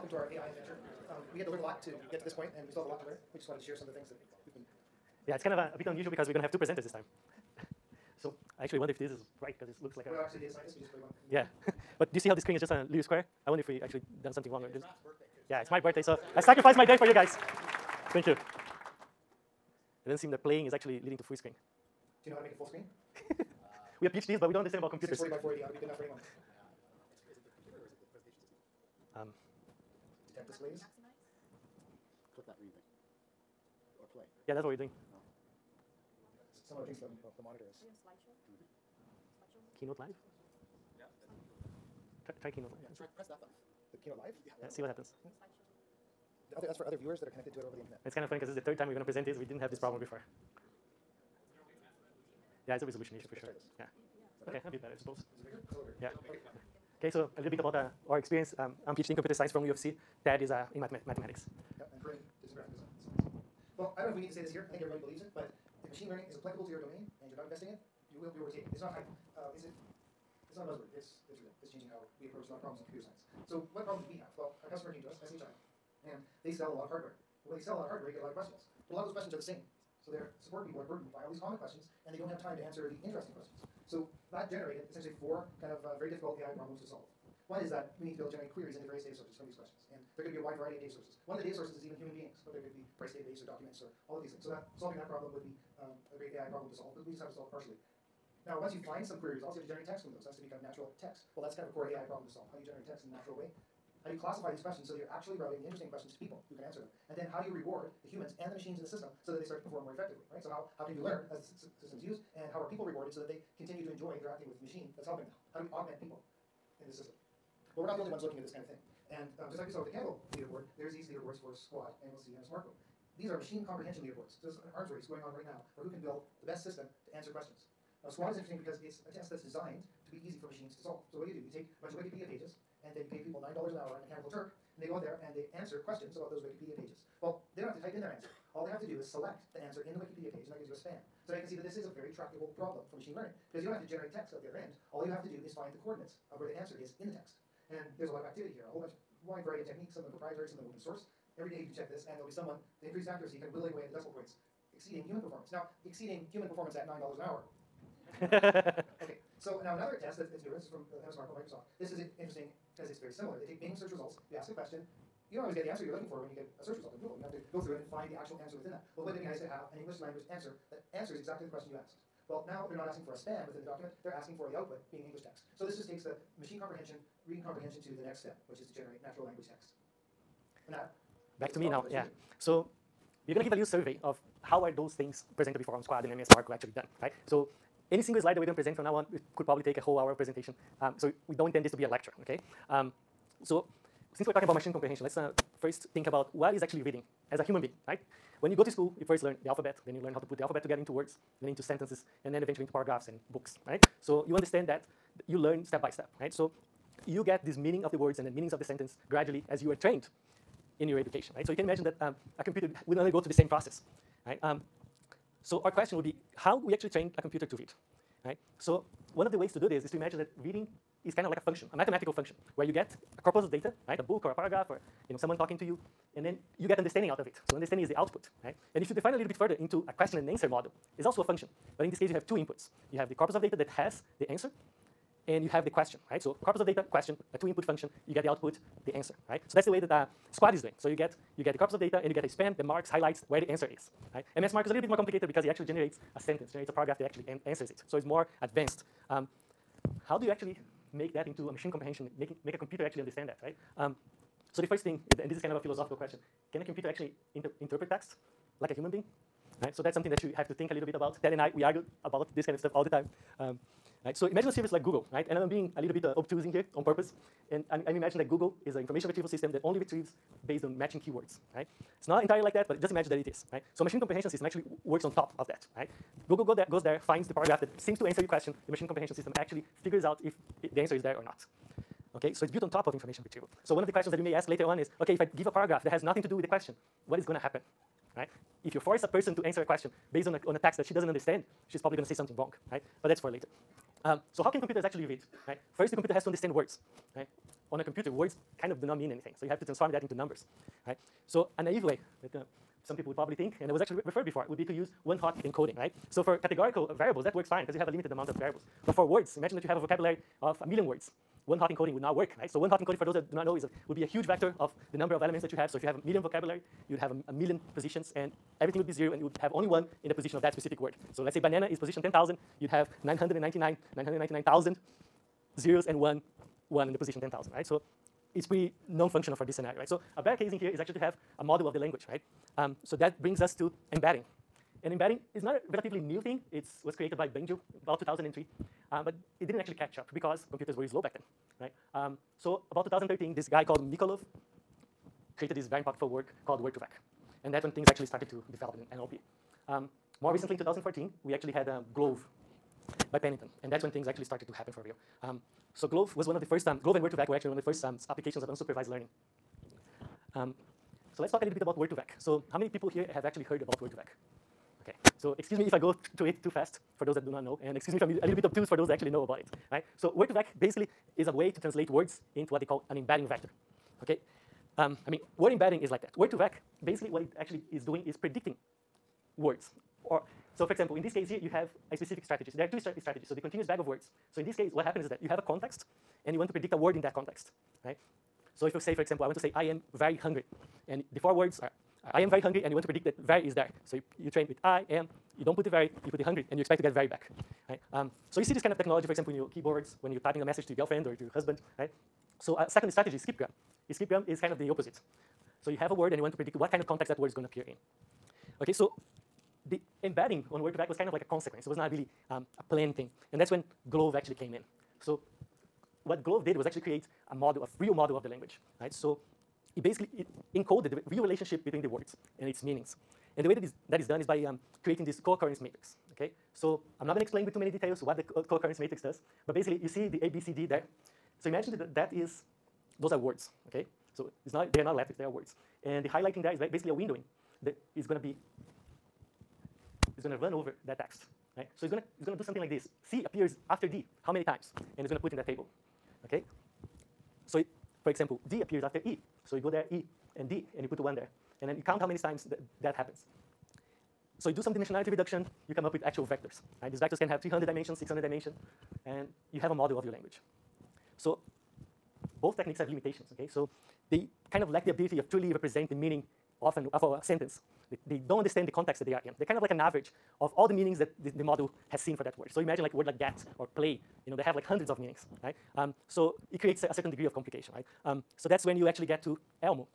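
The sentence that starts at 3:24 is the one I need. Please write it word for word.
So you understand that you learn step by step, right?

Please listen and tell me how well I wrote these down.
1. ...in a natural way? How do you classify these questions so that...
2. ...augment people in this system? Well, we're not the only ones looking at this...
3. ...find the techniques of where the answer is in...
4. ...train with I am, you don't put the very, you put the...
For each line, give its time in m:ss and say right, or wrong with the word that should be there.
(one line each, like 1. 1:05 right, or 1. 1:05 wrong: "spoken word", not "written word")
1. 1:43 right
2. 1:55 right
3. 2:25 wrong: "coordinates", not "techniques"
4. 6:34 right.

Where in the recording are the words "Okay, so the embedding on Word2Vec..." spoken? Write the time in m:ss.
6:48.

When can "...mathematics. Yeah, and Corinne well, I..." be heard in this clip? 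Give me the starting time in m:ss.
1:00.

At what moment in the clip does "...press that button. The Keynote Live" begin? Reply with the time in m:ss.
0:43.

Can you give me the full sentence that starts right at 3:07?
So any single slide that we're going to present from now on could probably take a whole hour of presentation.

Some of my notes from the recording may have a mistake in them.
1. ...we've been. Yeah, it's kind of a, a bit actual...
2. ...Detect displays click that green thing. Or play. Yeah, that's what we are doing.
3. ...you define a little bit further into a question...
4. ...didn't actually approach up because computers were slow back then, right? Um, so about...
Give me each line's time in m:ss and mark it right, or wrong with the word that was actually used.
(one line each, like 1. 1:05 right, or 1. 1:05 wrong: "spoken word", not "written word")
1. 0:04 wrong: "unusual", not "actual"
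2. 0:30 right
3. 3:48 right
4. 5:39 wrong: "catch", not "approach".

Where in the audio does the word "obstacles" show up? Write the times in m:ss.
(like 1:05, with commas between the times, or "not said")
not said.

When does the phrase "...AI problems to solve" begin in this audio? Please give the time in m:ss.
1:26.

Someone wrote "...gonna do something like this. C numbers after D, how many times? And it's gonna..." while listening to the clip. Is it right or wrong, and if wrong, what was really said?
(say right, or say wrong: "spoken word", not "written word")
wrong: "appears", not "numbers".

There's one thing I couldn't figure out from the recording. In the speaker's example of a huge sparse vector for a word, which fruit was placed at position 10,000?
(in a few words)
banana.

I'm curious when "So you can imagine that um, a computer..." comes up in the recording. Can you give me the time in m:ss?
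3:31.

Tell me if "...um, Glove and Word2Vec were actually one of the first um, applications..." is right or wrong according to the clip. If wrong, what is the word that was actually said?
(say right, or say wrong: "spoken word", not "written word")
right.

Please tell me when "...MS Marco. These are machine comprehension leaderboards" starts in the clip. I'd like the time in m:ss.
2:02.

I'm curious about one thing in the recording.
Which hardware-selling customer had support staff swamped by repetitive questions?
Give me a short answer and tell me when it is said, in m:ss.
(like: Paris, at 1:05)
SHI, at 1:15.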